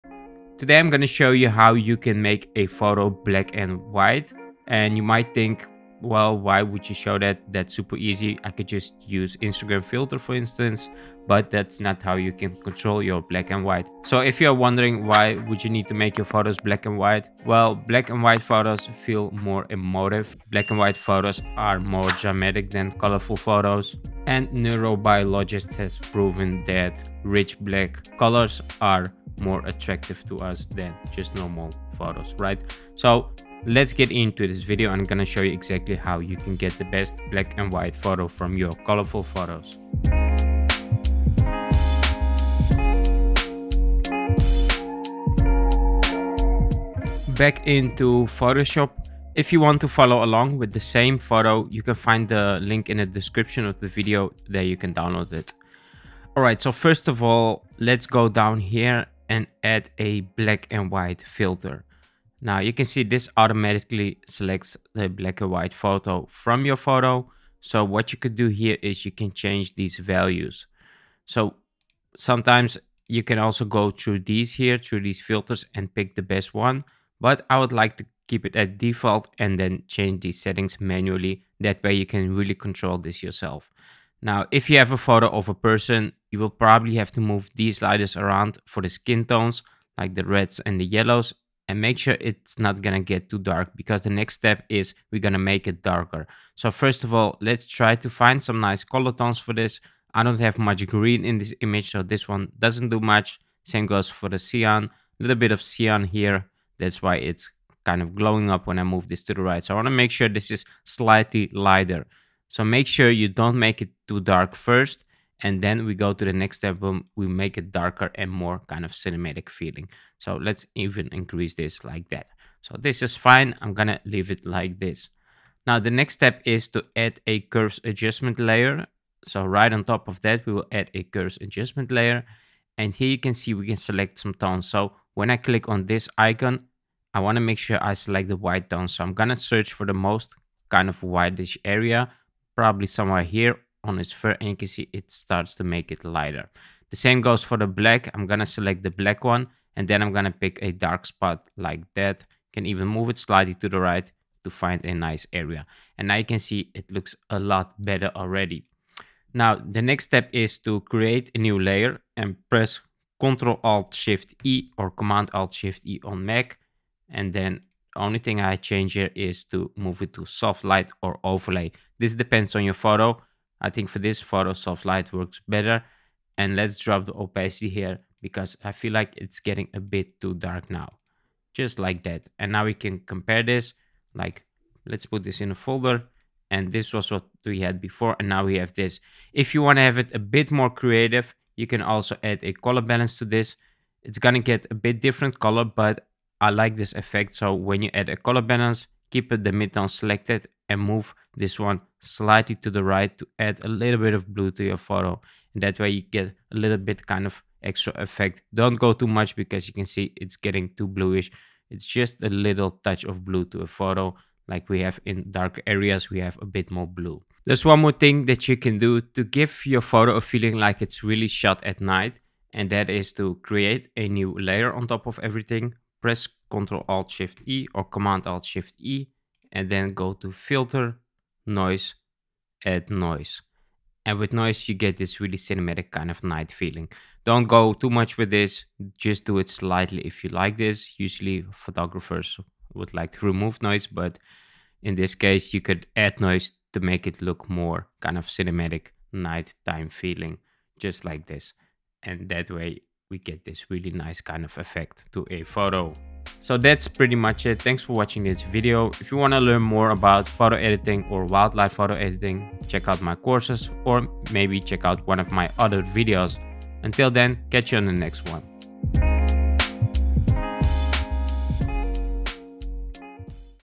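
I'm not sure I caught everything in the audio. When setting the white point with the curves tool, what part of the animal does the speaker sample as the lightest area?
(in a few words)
Its fur.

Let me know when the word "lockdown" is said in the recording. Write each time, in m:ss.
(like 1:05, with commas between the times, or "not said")
not said.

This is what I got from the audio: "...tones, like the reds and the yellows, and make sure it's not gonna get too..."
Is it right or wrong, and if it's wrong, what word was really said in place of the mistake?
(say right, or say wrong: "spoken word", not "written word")
right.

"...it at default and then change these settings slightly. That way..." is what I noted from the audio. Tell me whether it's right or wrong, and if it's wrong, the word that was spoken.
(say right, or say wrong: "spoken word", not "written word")
wrong: "manually", not "slightly".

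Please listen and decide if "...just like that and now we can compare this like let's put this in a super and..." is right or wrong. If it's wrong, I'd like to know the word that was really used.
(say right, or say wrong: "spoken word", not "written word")
wrong: "folder", not "super".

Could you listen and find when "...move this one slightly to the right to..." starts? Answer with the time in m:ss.
3:20.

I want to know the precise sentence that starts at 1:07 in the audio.
So what you could do here is you can change these values.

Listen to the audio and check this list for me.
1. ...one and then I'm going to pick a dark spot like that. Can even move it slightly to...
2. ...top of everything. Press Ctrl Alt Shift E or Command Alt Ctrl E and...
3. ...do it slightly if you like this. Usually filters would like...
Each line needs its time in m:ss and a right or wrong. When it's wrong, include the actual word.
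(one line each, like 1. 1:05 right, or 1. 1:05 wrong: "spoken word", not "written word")
1. 2:29 right
2. 3:44 wrong: "Shift", not "Ctrl"
3. 3:59 wrong: "photographers", not "filters".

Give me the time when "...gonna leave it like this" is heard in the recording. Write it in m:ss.
2:03.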